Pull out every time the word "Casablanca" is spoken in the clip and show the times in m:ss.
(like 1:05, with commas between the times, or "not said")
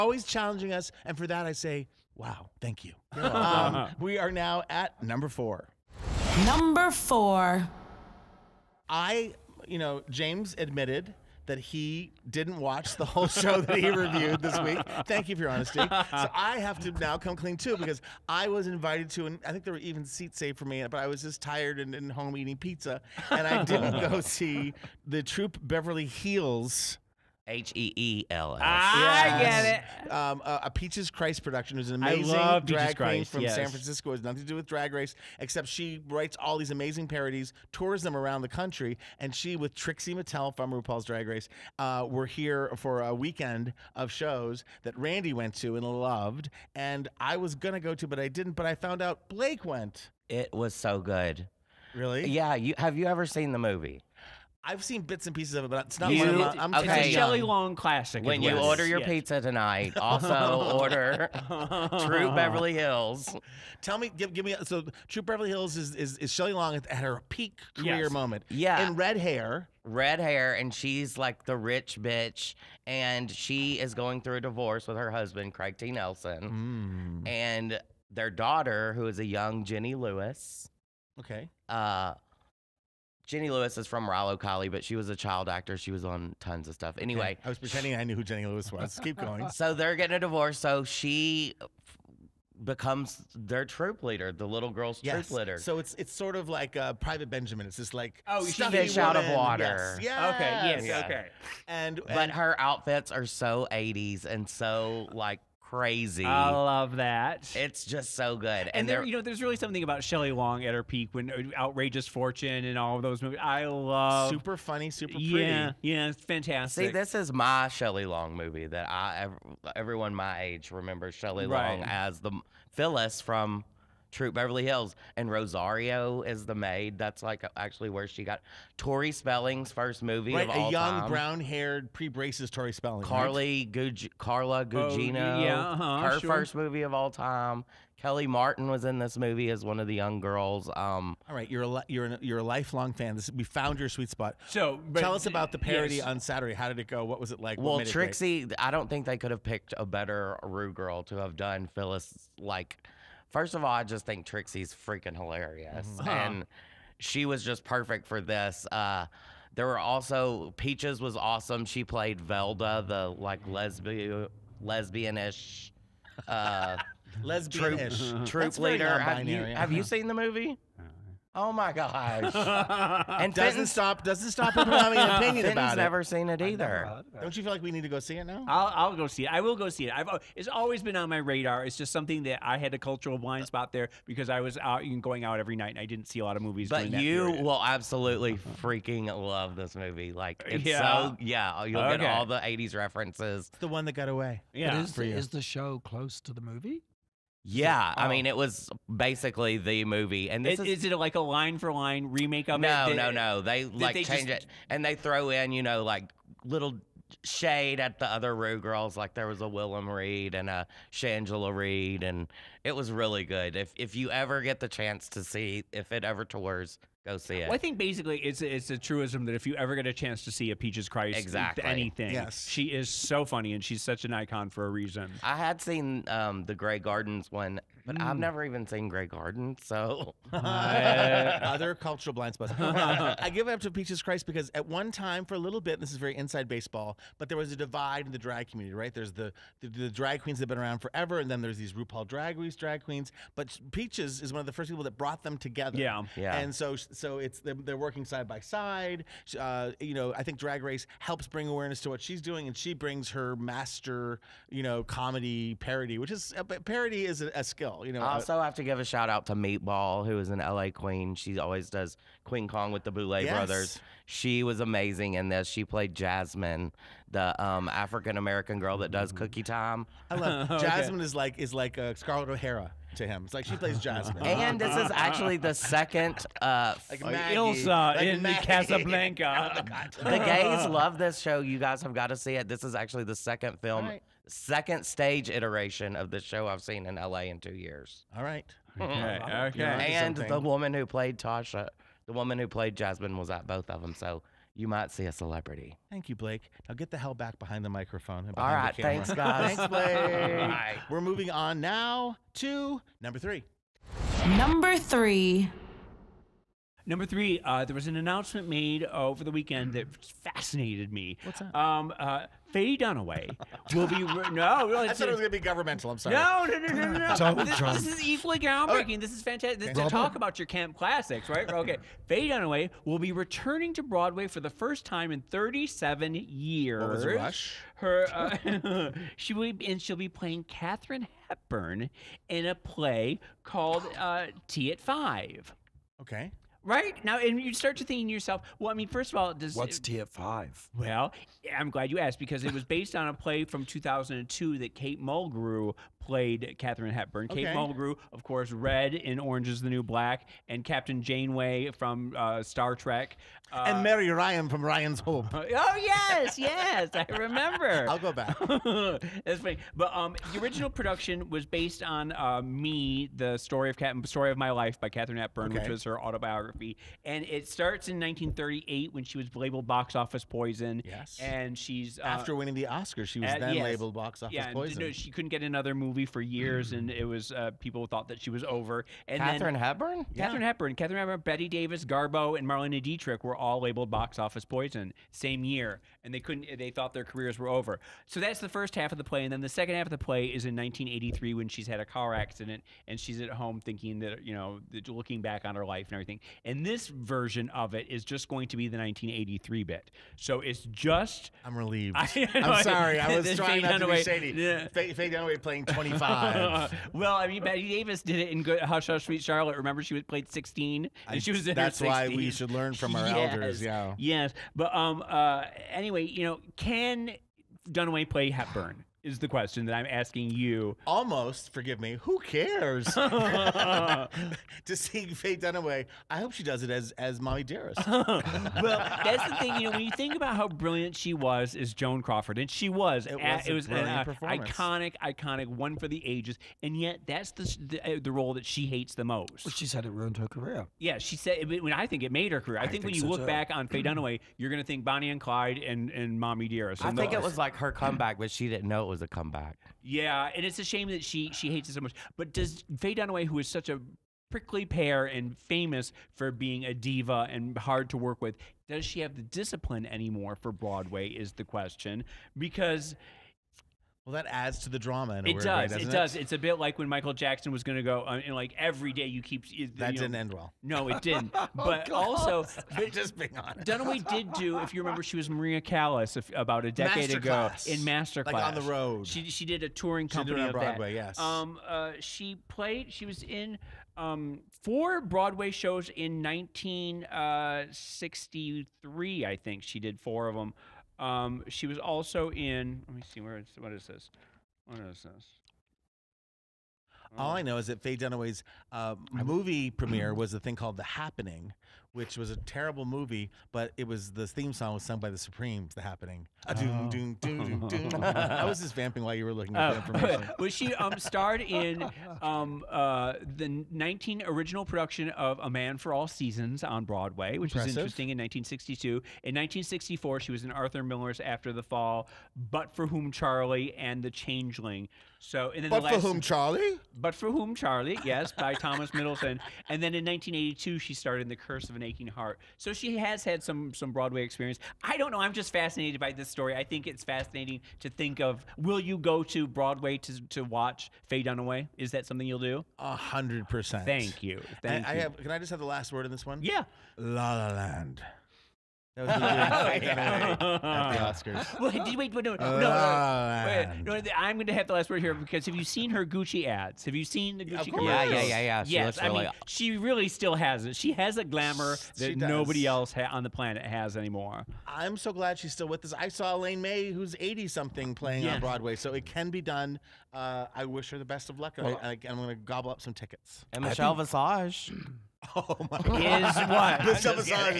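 4:38.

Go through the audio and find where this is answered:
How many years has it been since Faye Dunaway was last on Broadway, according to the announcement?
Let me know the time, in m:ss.
5:25.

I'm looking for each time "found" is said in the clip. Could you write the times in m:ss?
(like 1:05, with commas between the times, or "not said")
0:48, 2:23.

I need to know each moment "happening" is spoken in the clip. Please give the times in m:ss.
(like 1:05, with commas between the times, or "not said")
8:20, 8:25.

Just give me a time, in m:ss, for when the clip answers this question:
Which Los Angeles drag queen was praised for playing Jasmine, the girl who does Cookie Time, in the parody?
4:19.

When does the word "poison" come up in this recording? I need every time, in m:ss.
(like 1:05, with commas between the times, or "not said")
6:10, 6:14, 6:24.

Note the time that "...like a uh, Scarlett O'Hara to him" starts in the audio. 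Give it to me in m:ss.
4:31.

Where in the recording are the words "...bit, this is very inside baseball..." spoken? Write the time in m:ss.
3:55.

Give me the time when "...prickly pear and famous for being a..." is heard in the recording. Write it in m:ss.
7:34.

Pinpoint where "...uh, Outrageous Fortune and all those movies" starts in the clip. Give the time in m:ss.
1:51.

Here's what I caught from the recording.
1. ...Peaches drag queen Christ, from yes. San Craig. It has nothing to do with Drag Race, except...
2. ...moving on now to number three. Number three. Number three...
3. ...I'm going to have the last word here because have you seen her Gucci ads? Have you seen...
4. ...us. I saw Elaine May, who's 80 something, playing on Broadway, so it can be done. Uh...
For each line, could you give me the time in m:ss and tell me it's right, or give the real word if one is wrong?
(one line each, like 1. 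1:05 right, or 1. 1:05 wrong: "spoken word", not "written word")
1. 0:32 wrong: "Francisco", not "Craig"
2. 5:01 right
3. 9:14 right
4. 9:25 right.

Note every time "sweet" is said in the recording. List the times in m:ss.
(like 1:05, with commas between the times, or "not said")
2:23, 6:49.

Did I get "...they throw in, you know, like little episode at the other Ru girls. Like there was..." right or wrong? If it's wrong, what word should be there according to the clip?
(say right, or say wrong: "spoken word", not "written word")
wrong: "shade", not "episode".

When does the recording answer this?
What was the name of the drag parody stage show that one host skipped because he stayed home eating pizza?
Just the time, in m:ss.
0:25.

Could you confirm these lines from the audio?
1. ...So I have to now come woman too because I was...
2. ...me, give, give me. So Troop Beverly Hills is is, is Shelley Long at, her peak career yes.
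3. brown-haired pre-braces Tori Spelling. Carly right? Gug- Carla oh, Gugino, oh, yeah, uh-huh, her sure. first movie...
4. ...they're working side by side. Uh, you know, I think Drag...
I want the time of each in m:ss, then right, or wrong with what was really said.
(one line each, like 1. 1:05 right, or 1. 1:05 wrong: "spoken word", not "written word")
1. 0:15 wrong: "clean", not "woman"
2. 1:03 right
3. 2:11 right
4. 4:07 right.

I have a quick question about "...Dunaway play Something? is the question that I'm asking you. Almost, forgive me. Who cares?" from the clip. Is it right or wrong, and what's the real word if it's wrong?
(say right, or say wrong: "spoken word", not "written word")
wrong: "Hepburn", not "Something".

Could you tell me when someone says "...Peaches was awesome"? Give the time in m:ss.
2:40.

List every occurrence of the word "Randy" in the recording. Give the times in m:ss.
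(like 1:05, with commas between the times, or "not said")
0:44.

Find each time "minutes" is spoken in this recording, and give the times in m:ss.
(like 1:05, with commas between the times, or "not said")
not said.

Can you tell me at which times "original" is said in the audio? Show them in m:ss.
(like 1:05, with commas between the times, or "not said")
6:00, 8:34.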